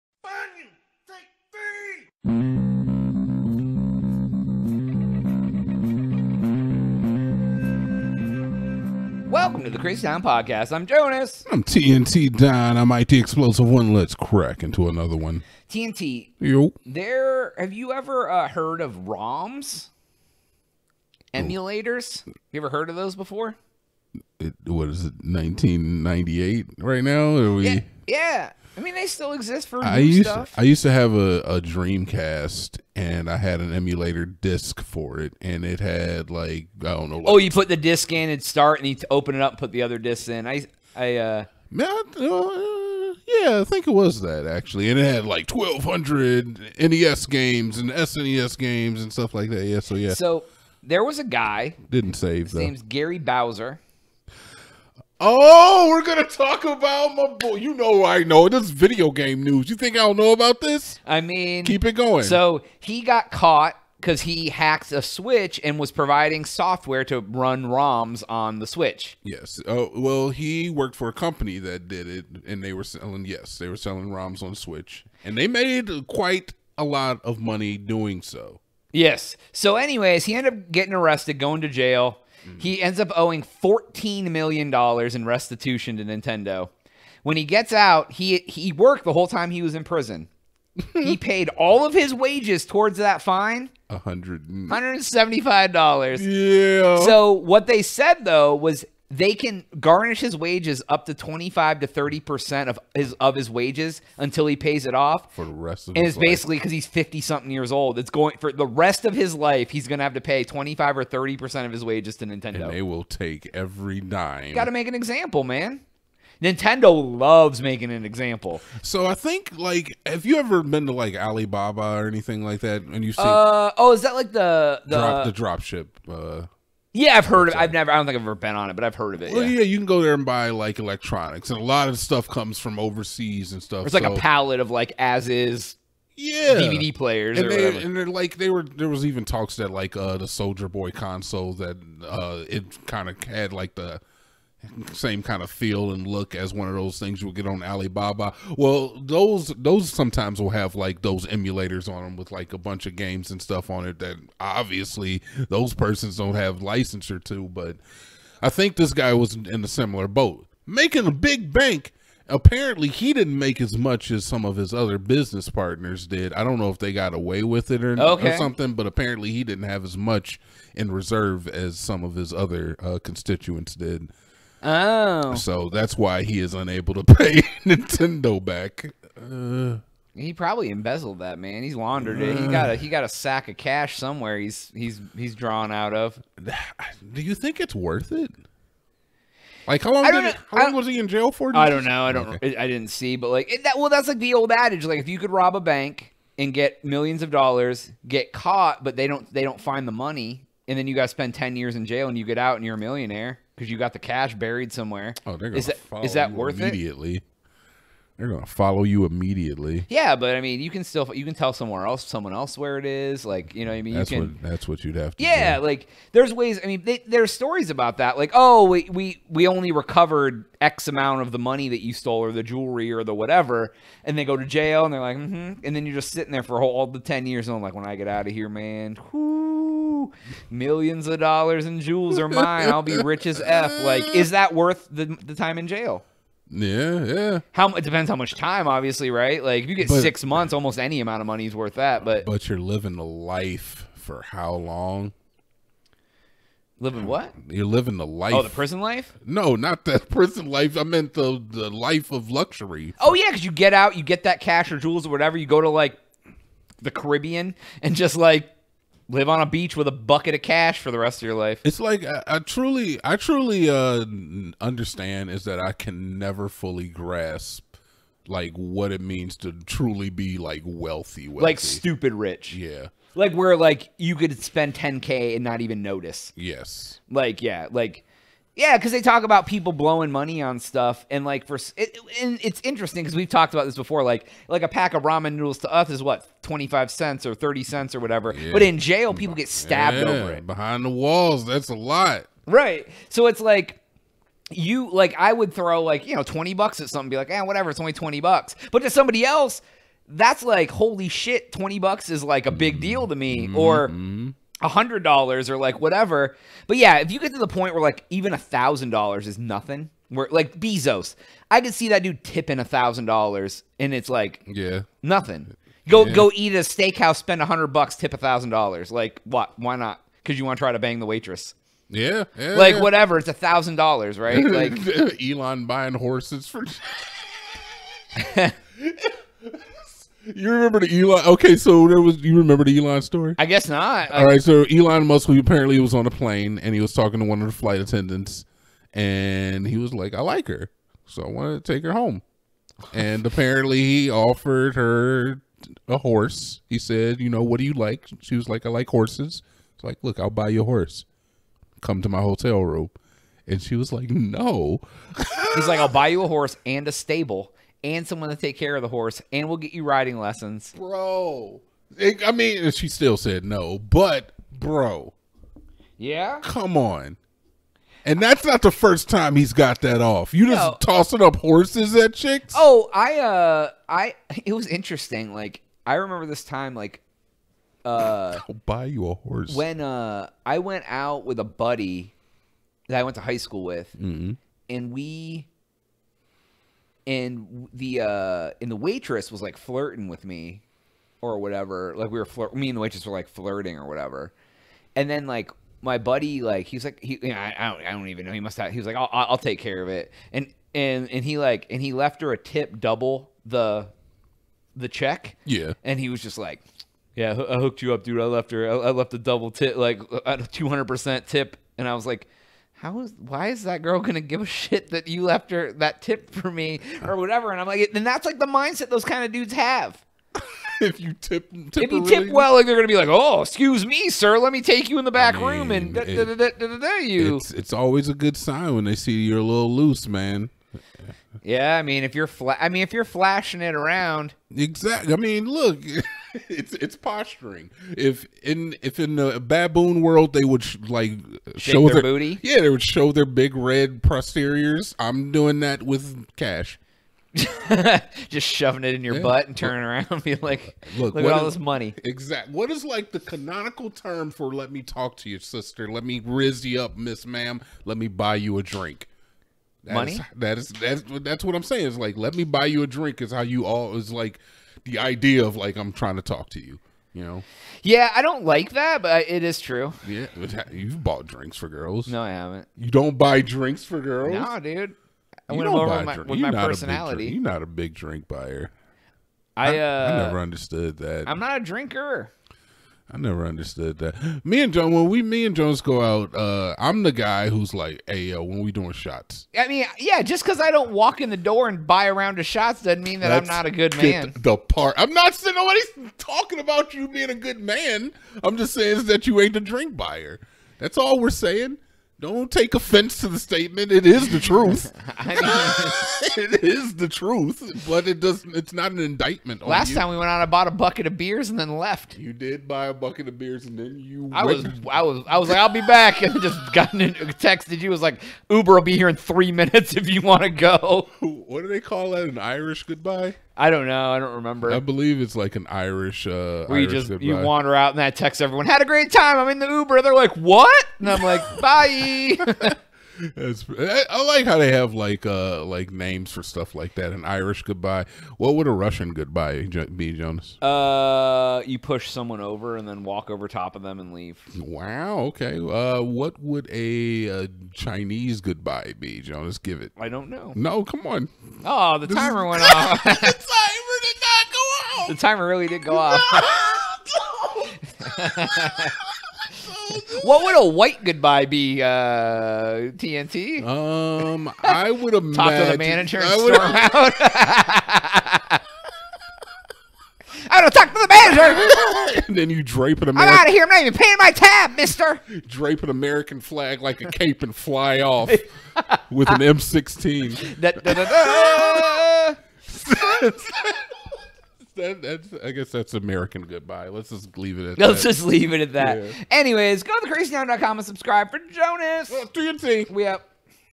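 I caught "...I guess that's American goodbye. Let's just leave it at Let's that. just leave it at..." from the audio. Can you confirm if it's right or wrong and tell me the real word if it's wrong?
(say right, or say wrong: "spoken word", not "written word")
right.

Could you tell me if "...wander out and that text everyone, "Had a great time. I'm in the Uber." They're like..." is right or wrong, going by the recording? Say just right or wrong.
right.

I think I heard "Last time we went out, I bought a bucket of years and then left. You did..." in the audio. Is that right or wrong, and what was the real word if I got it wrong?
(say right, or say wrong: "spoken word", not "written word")
wrong: "beers", not "years".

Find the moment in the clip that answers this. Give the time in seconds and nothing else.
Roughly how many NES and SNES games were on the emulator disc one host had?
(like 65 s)
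45 s.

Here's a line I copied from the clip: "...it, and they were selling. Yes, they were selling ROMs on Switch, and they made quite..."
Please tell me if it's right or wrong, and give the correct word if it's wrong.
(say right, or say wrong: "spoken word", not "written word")
right.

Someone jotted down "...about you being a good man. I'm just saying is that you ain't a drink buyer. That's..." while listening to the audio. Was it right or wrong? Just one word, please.
right.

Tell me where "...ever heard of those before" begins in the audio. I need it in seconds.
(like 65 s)
22 s.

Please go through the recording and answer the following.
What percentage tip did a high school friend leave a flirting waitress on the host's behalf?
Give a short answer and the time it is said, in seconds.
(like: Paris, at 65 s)
200 percent, at 410 s.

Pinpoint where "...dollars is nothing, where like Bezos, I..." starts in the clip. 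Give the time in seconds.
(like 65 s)
308 s.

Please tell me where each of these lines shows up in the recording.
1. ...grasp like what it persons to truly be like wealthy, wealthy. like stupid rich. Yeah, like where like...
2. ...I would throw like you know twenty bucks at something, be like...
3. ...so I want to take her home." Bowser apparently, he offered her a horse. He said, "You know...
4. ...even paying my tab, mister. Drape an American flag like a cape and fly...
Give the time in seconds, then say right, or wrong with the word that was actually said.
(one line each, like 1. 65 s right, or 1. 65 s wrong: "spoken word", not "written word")
1. 266 s wrong: "means", not "persons"
2. 295 s right
3. 341 s wrong: "And", not "Bowser"
4. 573 s right.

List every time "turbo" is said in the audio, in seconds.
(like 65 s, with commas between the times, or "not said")
not said.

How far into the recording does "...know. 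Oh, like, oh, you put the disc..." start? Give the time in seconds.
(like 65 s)
37 s.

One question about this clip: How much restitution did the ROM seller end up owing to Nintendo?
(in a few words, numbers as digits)
$14 million.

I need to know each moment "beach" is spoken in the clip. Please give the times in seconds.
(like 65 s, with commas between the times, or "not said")
259 s.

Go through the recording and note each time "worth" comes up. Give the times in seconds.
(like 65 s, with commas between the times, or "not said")
187 s, 206 s, 234 s, 241 s.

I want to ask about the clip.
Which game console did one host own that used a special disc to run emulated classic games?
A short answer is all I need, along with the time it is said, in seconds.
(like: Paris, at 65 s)
Dreamcast, at 31 s.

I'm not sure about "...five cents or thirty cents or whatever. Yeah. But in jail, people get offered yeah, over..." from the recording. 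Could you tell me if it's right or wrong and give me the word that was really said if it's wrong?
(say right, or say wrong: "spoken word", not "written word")
wrong: "stabbed", not "offered".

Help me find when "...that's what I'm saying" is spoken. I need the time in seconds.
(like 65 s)
461 s.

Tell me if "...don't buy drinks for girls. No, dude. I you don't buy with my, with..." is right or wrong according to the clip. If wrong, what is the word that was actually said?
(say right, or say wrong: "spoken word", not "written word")
right.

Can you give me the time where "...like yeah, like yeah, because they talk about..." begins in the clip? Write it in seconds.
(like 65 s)
277 s.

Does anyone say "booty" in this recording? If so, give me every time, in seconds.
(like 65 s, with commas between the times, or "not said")
442 s.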